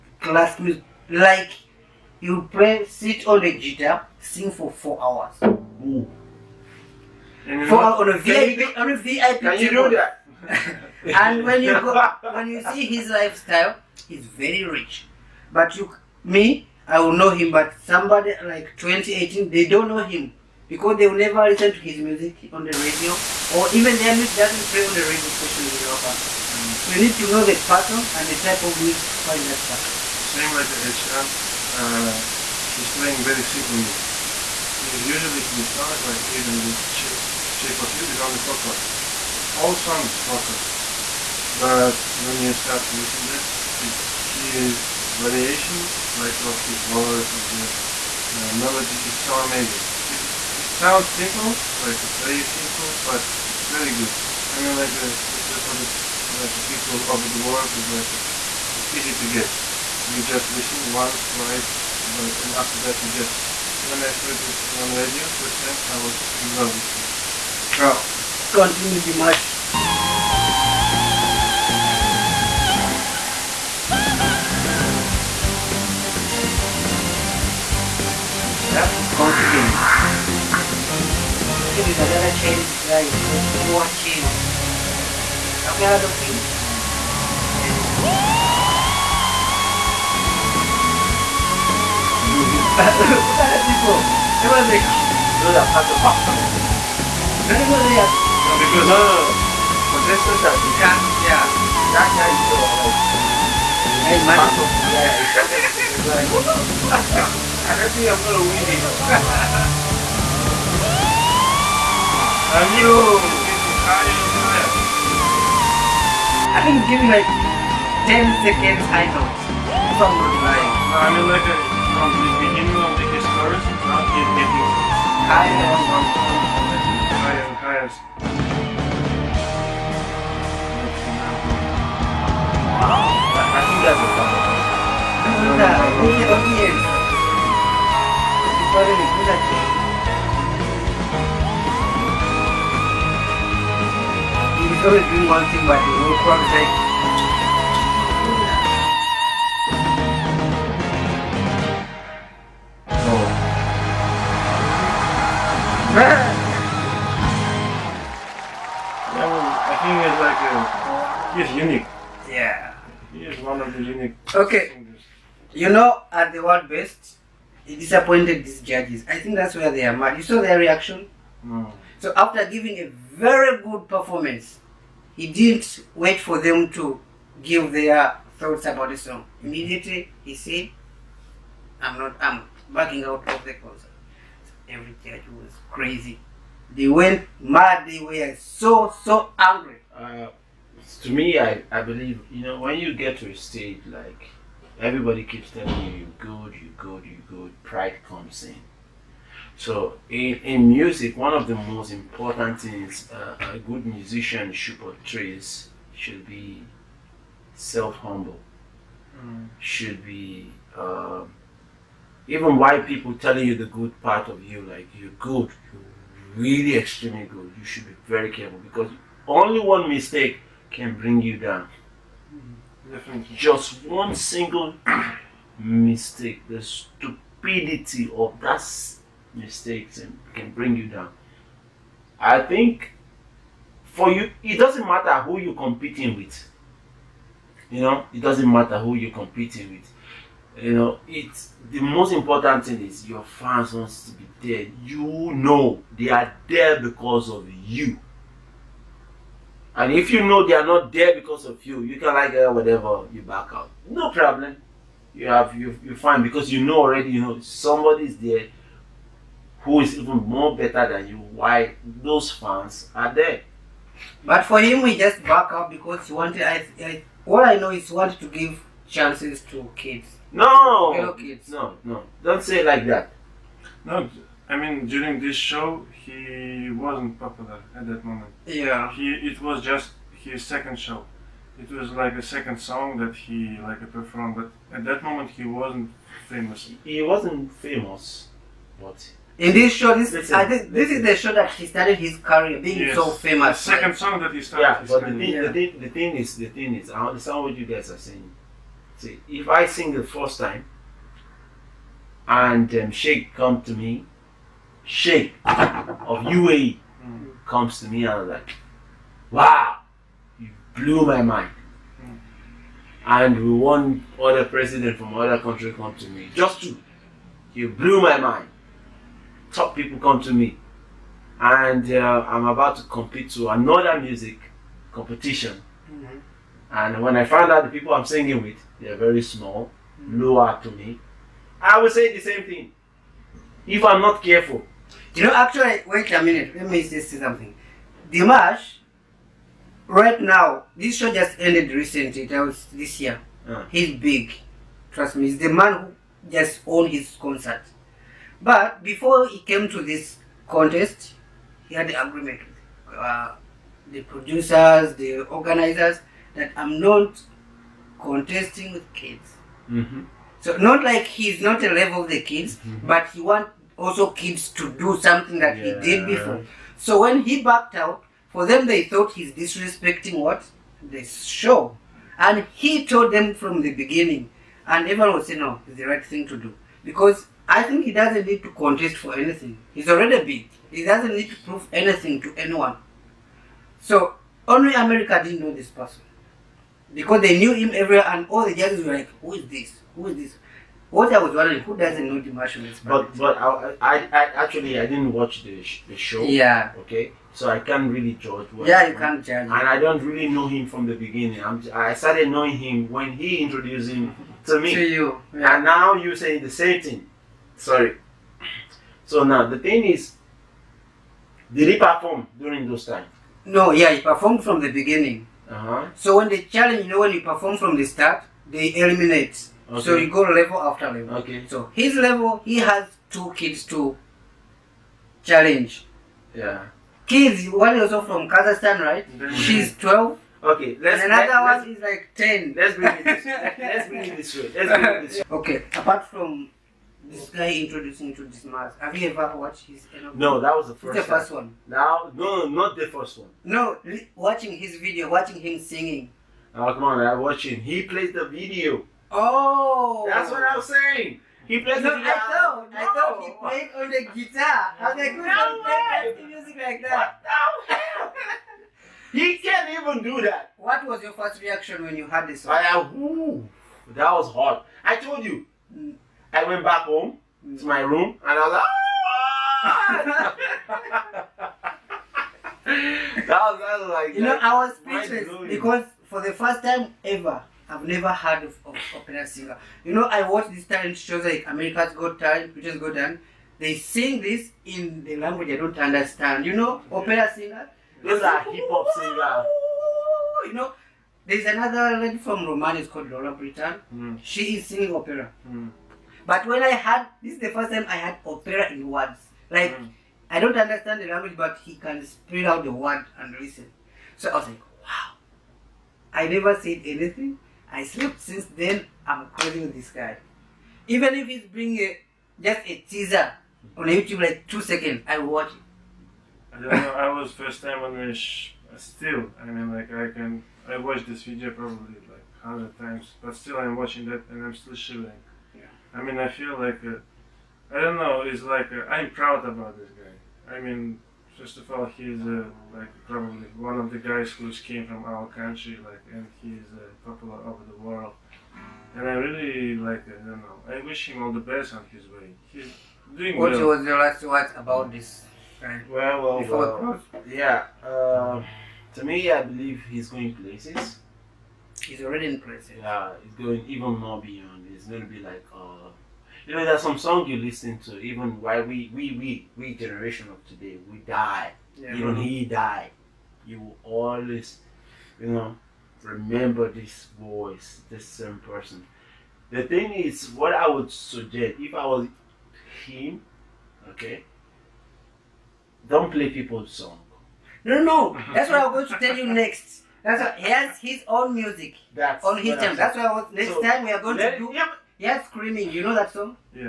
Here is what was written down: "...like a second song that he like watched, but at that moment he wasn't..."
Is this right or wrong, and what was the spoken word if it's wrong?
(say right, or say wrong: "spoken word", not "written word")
wrong: "performed", not "watched".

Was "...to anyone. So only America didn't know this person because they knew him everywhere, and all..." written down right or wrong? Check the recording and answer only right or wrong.
right.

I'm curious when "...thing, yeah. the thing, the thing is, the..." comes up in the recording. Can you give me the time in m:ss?
4:55.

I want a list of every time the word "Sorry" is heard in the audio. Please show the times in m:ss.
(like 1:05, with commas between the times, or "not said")
6:47.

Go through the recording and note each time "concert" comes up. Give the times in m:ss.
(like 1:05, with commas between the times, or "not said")
3:03, 5:47.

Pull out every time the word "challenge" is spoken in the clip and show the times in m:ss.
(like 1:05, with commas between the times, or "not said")
6:56, 7:05.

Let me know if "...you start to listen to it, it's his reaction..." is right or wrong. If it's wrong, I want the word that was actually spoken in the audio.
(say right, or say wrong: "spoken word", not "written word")
wrong: "variation", not "reaction".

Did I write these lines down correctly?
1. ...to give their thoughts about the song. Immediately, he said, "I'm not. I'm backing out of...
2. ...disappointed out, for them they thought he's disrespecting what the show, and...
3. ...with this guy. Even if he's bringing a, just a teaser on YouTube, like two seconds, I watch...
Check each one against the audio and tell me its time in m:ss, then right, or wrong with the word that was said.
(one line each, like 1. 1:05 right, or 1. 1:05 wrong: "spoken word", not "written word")
1. 2:56 right
2. 6:07 wrong: "backed", not "disappointed"
3. 8:29 right.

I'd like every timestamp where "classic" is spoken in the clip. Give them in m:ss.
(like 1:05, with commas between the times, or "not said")
0:00.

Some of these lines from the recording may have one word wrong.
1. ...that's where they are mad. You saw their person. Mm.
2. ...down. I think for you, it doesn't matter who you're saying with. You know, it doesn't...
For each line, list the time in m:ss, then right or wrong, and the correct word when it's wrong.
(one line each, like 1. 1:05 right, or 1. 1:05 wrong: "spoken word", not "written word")
1. 2:49 wrong: "reaction", not "person"
2. 3:50 wrong: "competing", not "saying".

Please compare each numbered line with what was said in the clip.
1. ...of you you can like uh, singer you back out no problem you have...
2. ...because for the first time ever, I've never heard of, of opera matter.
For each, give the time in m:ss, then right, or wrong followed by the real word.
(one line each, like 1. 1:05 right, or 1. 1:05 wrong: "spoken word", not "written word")
1. 4:11 wrong: "whatever", not "singer"
2. 7:55 wrong: "singer", not "matter".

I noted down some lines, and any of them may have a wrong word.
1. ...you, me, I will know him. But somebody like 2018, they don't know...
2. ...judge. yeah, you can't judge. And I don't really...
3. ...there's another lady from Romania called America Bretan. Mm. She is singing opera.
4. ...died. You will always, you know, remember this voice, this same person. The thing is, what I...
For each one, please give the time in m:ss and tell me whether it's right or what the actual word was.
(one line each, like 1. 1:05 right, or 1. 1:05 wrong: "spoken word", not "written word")
1. 0:15 right
2. 6:38 right
3. 8:11 wrong: "Laura", not "America"
4. 9:22 right.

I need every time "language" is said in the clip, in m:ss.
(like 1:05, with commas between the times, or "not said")
8:05, 8:21.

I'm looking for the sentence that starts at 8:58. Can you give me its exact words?
And I really like, I don't know, I wish him all the best on his way.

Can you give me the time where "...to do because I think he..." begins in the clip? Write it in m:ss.
6:16.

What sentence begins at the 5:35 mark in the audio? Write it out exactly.
You know, actually, wait a minute, let me just say something.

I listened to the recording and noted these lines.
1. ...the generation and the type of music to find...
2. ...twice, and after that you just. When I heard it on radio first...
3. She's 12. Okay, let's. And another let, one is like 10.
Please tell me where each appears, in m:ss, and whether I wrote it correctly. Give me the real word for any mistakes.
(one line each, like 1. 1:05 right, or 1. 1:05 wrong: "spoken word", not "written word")
1. 0:27 wrong: "person", not "generation"
2. 1:01 right
3. 7:09 right.